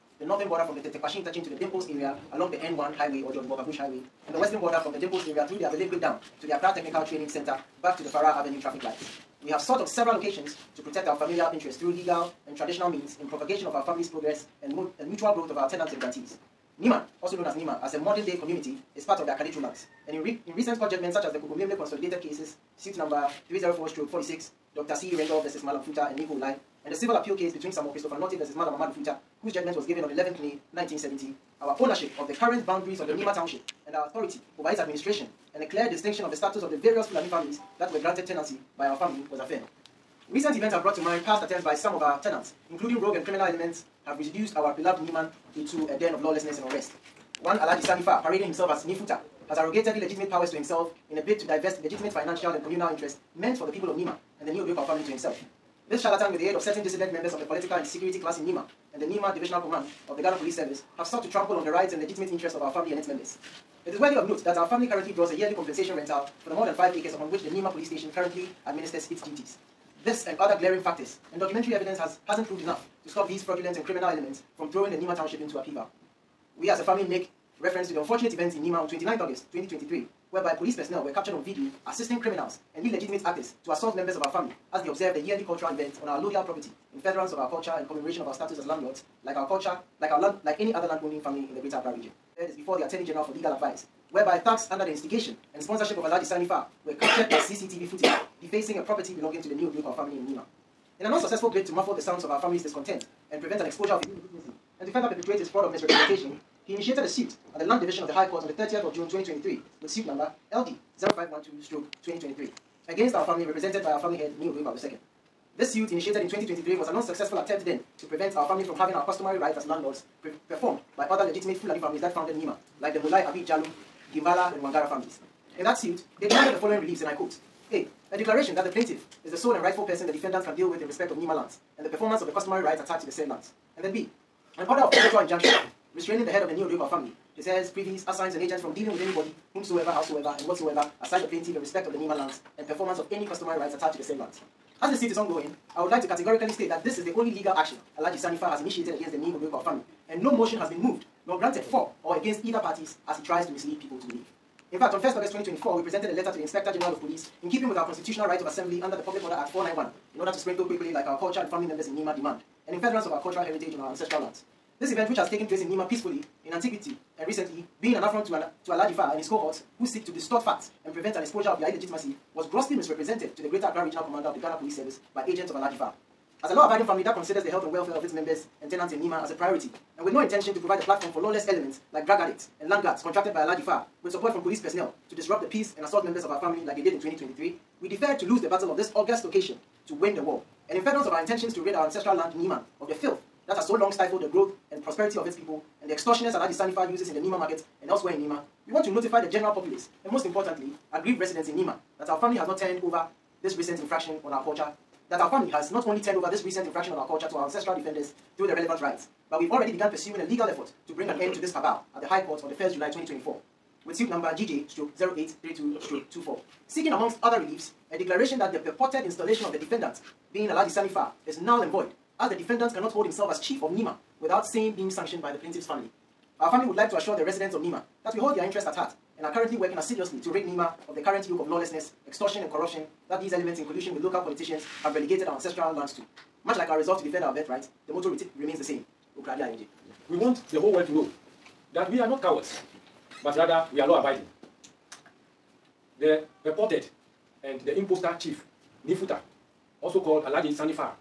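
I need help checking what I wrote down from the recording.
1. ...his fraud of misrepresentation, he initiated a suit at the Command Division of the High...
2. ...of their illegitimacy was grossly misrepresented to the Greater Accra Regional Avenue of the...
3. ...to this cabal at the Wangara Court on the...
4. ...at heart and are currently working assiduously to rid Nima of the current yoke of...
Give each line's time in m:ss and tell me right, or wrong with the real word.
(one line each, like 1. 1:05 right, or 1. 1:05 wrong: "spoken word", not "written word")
1. 1:45 wrong: "Land", not "Command"
2. 2:51 wrong: "Commander", not "Avenue"
3. 3:31 wrong: "High", not "Wangara"
4. 3:48 right.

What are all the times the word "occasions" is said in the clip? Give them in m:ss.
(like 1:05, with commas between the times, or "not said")
0:10, 3:09.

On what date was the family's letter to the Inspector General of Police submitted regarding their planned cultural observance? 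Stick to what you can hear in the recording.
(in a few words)
1 August 2024.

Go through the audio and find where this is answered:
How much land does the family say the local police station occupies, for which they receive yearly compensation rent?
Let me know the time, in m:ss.
1:06.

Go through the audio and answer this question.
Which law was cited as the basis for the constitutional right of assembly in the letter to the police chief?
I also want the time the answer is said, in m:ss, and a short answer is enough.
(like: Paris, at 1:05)
Public Order Act 491, at 2:39.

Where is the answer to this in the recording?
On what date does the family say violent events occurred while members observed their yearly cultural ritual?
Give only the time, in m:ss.
1:18.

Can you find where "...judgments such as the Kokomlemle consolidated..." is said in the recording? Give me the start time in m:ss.
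0:20.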